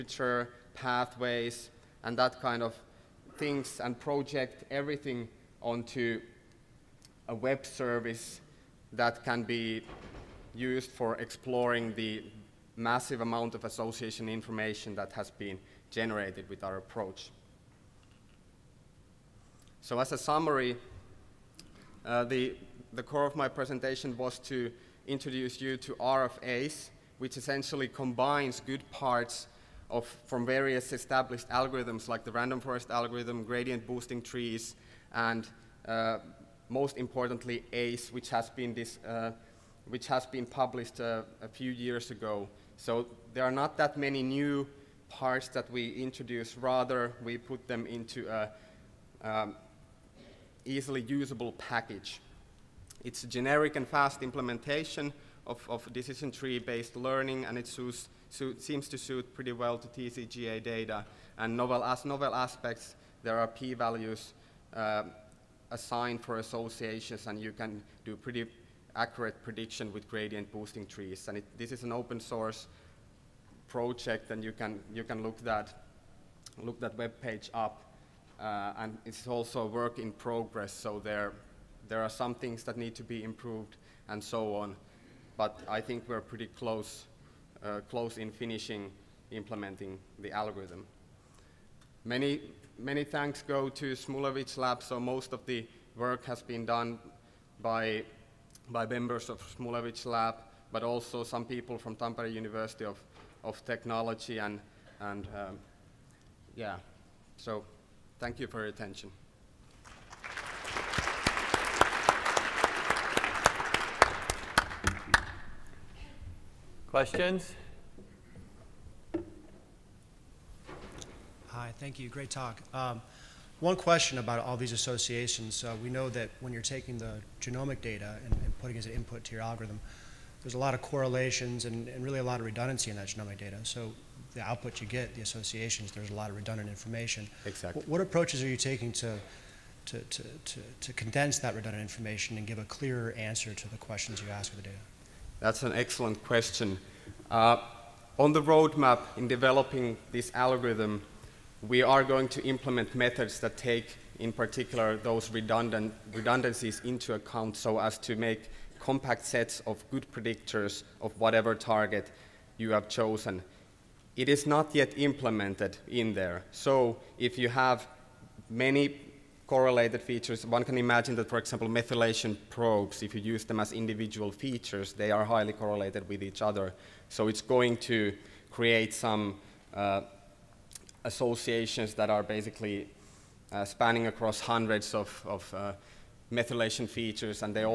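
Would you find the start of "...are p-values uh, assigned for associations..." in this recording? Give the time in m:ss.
1:03.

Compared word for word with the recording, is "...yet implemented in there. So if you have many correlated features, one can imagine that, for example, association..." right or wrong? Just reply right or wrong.
wrong.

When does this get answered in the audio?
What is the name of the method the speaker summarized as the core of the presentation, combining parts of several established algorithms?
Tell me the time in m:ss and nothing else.
0:25.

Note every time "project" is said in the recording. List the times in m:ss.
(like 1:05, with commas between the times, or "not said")
0:03, 1:13.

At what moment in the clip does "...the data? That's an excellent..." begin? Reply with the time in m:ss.
2:24.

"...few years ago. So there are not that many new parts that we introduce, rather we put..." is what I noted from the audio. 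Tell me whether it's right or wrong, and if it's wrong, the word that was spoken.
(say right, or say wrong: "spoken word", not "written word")
right.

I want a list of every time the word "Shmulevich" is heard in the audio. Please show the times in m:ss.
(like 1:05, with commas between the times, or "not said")
1:33, 1:39.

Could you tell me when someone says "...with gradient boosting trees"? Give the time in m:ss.
1:09.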